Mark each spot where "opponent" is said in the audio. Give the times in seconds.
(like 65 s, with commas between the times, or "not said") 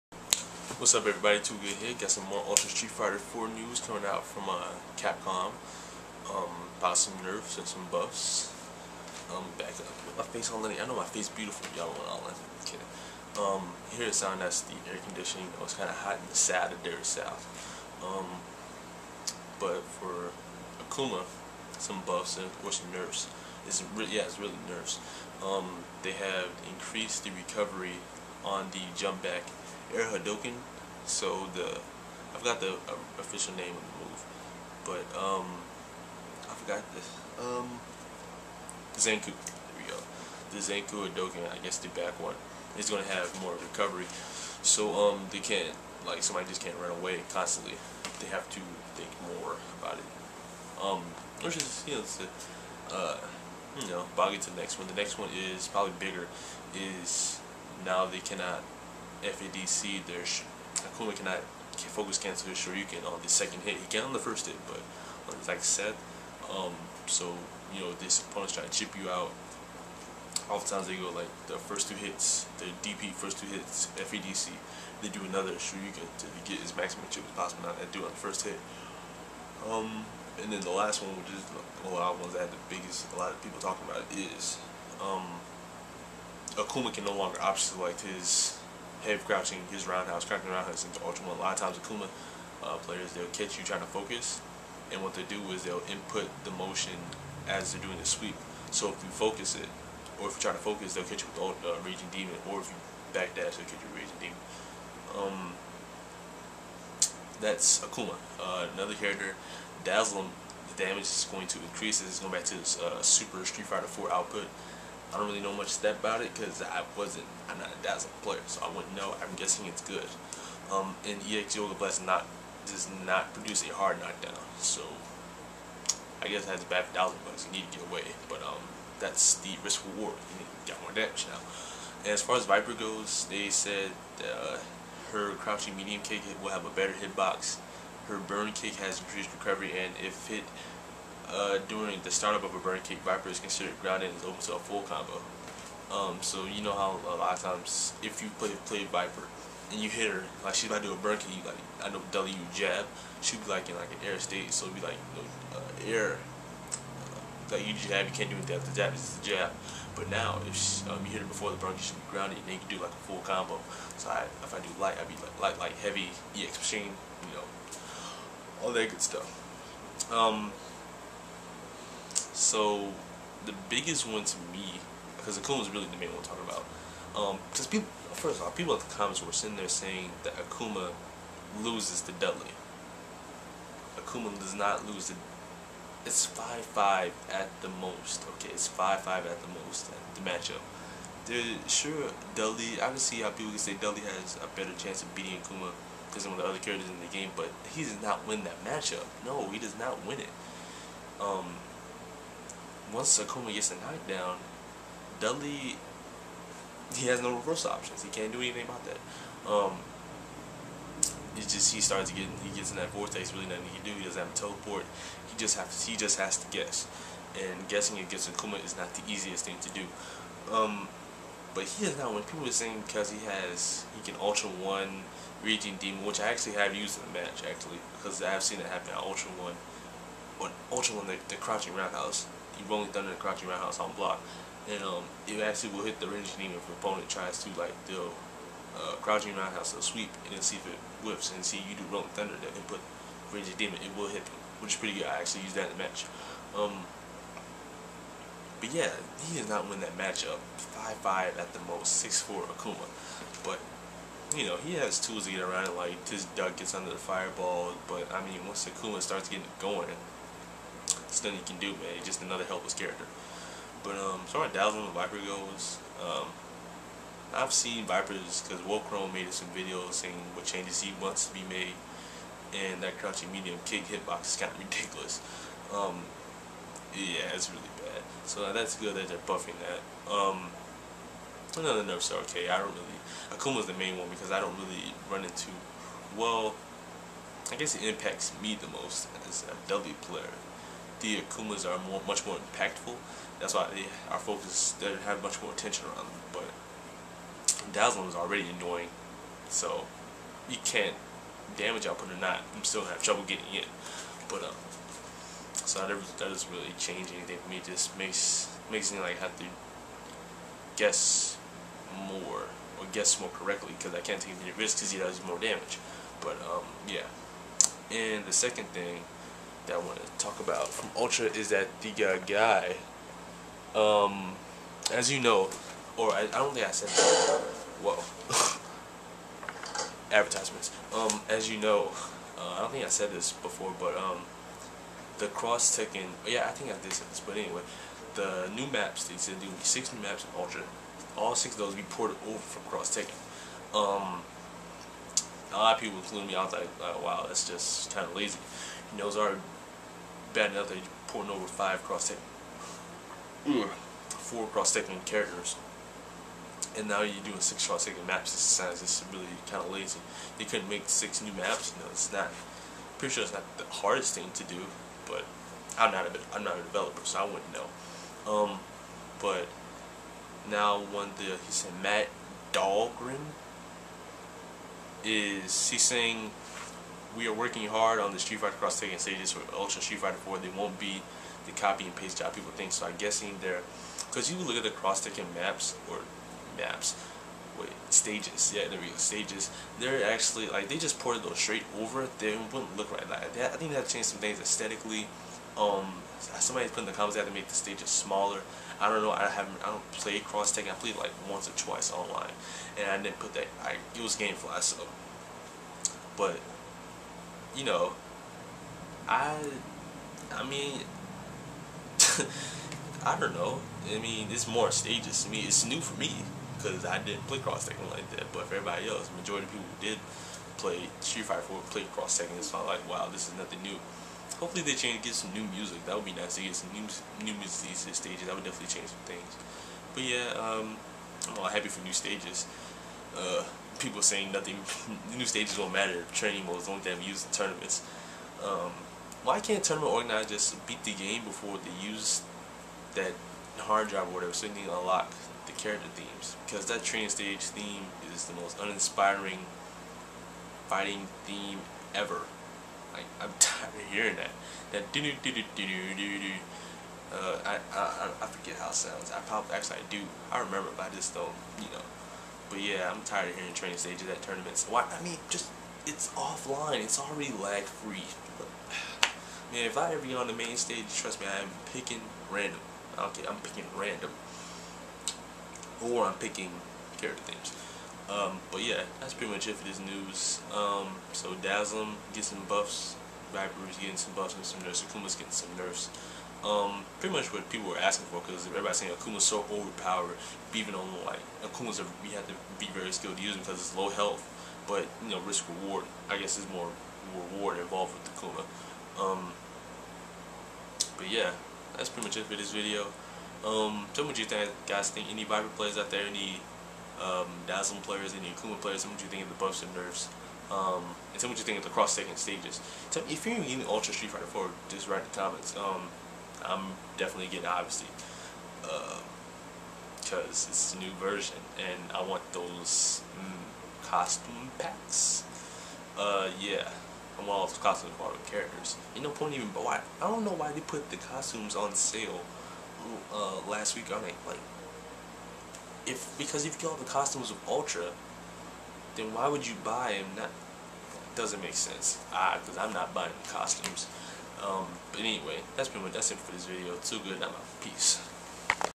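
68 s, 236 s.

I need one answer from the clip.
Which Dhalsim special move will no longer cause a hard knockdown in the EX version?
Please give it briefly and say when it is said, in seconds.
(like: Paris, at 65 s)
Yoga Blast, at 121 s.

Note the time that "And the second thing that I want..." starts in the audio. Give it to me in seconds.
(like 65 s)
317 s.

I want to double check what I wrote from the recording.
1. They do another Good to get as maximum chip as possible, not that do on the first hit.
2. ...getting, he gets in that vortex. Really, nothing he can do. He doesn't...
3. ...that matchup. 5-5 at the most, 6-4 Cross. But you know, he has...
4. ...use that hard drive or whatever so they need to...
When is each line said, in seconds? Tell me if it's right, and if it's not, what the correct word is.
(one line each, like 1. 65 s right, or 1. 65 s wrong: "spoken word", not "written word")
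1. 75 s wrong: "Shoryuken", not "Good"
2. 212 s right
3. 249 s wrong: "Akuma", not "Cross"
4. 441 s right.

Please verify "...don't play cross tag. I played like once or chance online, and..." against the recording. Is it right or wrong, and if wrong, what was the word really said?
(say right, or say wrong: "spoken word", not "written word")
wrong: "twice", not "chance".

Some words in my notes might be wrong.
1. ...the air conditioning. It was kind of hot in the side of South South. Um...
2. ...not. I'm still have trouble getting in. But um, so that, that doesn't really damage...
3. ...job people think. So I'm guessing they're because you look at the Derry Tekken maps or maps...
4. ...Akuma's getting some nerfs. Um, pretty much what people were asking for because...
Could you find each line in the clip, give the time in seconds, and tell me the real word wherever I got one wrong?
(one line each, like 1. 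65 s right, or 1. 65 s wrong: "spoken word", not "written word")
1. 14 s wrong: "Derry", not "South"
2. 302 s wrong: "change", not "damage"
3. 382 s wrong: "Cross", not "Derry"
4. 484 s right.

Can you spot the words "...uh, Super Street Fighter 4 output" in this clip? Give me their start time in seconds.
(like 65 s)
112 s.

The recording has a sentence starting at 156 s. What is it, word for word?
Uh, like you jab, you can't do anything after jab.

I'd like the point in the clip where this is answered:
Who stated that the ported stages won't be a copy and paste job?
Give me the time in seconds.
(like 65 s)
371 s.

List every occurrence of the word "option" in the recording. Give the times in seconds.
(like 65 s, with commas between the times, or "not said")
87 s, 207 s.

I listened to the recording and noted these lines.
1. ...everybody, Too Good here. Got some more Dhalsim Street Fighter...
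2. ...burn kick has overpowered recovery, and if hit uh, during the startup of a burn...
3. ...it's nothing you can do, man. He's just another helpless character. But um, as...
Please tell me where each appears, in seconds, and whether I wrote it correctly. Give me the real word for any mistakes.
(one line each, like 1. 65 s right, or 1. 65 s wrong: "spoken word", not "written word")
1. 1 s wrong: "Ultra", not "Dhalsim"
2. 138 s wrong: "increased", not "overpowered"
3. 261 s right.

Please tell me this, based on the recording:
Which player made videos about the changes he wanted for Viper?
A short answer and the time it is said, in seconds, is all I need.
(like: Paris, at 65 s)
Wolfkrone, at 268 s.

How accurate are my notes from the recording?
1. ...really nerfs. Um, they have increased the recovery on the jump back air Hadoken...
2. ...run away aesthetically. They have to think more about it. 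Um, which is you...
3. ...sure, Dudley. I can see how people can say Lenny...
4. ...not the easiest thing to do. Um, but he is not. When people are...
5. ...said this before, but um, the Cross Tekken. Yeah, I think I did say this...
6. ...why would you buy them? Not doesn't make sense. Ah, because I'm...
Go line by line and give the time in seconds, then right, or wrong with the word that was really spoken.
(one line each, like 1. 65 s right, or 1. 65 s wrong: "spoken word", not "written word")
1. 24 s right
2. 46 s wrong: "constantly", not "aesthetically"
3. 191 s wrong: "Dudley", not "Lenny"
4. 218 s right
5. 332 s right
6. 539 s right.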